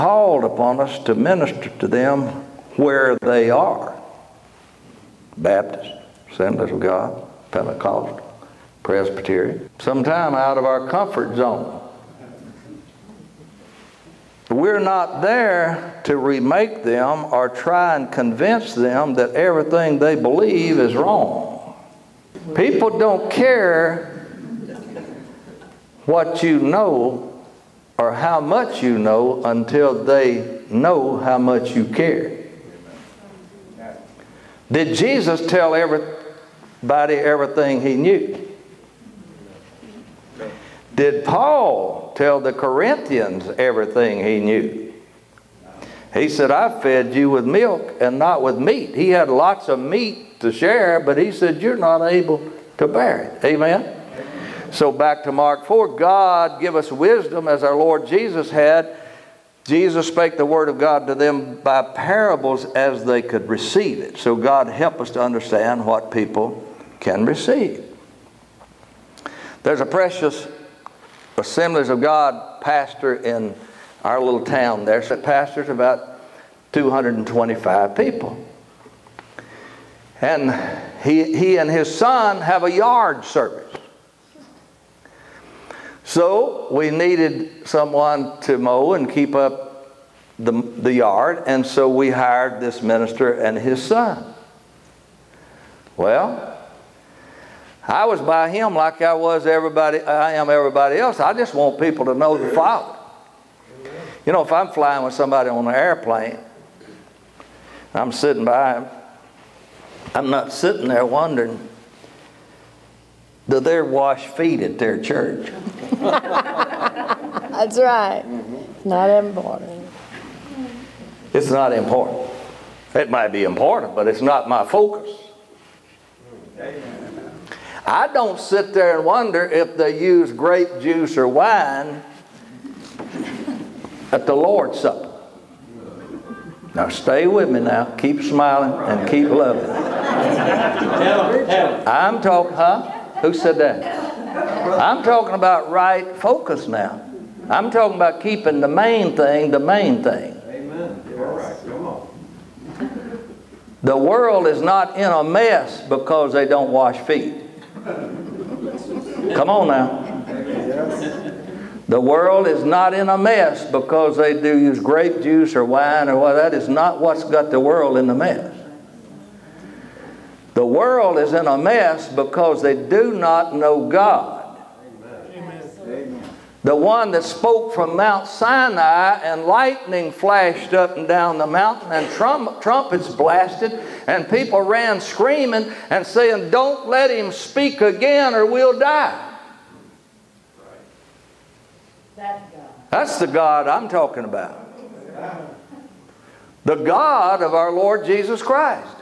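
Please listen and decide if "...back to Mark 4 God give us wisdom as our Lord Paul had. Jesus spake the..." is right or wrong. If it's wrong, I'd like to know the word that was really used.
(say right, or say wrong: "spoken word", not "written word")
wrong: "Jesus", not "Paul".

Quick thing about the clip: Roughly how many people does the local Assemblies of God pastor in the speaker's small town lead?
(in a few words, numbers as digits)
225.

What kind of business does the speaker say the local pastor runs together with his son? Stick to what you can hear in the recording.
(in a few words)
yard service.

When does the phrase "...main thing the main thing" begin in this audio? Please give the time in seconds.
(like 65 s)
148 s.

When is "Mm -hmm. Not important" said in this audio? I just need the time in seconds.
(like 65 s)
118 s.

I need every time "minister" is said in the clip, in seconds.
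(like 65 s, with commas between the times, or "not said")
1 s, 92 s.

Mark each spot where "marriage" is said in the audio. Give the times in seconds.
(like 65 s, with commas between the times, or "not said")
not said.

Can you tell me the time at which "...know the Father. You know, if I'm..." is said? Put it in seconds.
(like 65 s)
102 s.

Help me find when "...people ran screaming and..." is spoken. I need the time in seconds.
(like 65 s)
184 s.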